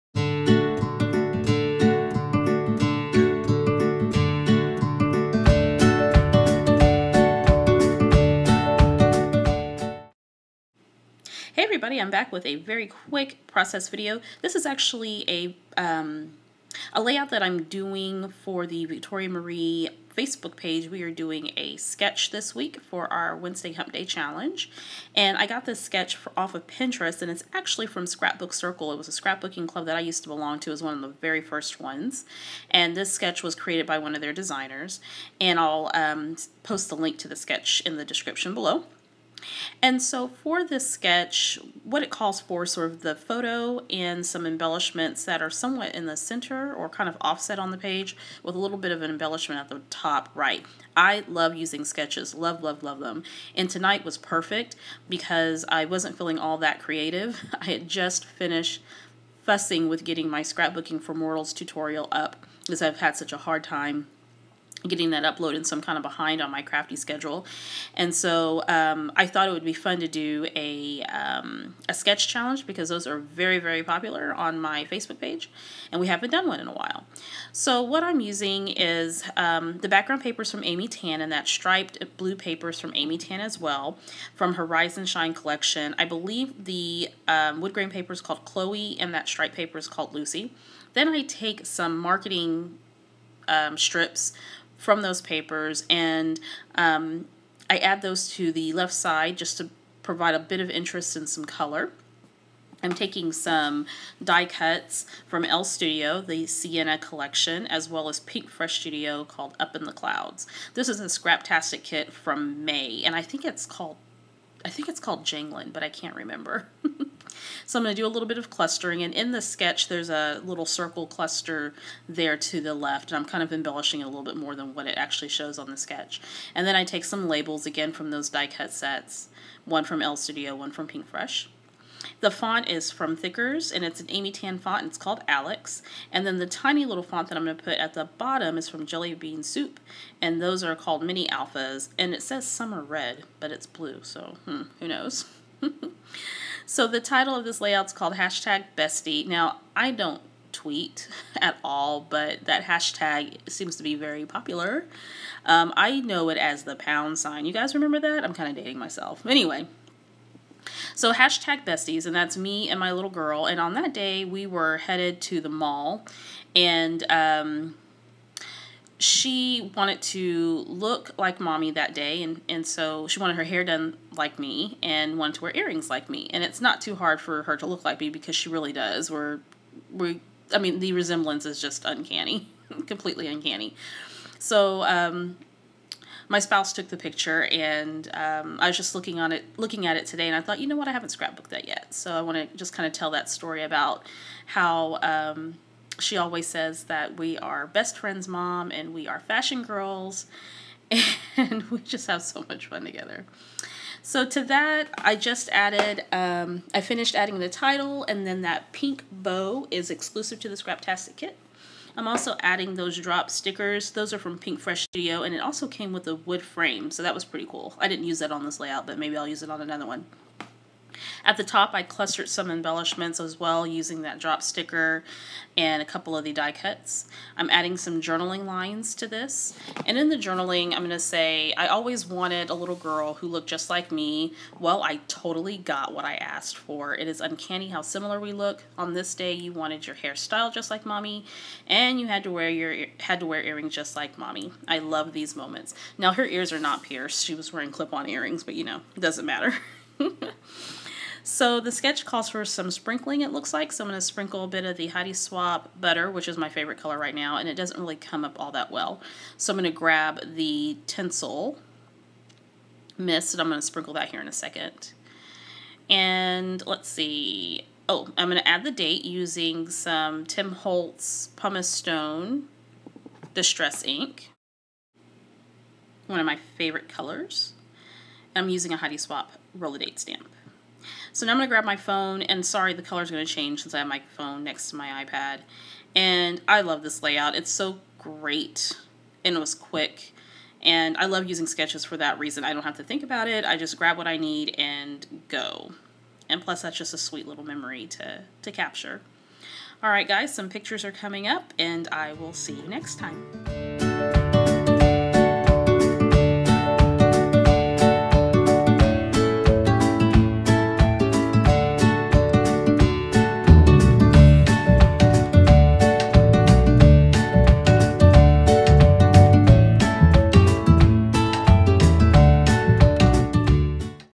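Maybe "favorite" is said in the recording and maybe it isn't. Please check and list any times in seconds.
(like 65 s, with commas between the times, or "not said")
256 s, 276 s.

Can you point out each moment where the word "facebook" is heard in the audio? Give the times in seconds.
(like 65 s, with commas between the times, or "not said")
20 s, 74 s.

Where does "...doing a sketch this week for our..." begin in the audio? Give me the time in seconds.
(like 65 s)
21 s.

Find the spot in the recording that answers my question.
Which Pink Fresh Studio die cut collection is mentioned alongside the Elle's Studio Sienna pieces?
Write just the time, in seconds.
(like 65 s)
109 s.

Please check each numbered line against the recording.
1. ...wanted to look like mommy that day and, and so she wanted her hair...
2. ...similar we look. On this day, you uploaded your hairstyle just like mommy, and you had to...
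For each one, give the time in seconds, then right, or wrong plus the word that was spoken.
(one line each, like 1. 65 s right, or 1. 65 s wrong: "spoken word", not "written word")
1. 169 s right
2. 237 s wrong: "wanted", not "uploaded".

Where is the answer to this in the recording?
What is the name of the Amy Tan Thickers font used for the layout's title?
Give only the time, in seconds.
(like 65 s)
135 s.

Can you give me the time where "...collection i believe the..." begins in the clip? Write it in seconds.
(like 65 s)
85 s.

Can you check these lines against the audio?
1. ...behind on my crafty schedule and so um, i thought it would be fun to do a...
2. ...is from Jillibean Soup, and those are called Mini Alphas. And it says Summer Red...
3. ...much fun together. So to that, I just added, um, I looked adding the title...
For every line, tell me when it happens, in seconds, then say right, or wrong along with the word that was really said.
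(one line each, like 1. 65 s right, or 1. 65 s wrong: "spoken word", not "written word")
1. 66 s right
2. 138 s right
3. 202 s wrong: "finished", not "looked".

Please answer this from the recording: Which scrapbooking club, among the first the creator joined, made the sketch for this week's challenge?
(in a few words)
Scrapbook Circle.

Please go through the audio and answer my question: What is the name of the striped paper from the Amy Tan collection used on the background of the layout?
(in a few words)
Lucy.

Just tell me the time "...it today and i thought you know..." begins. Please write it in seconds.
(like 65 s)
189 s.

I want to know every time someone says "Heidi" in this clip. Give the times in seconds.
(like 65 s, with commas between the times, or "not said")
254 s, 278 s.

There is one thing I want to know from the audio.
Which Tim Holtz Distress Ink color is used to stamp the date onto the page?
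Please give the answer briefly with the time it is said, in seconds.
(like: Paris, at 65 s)
Pumice Stone, at 271 s.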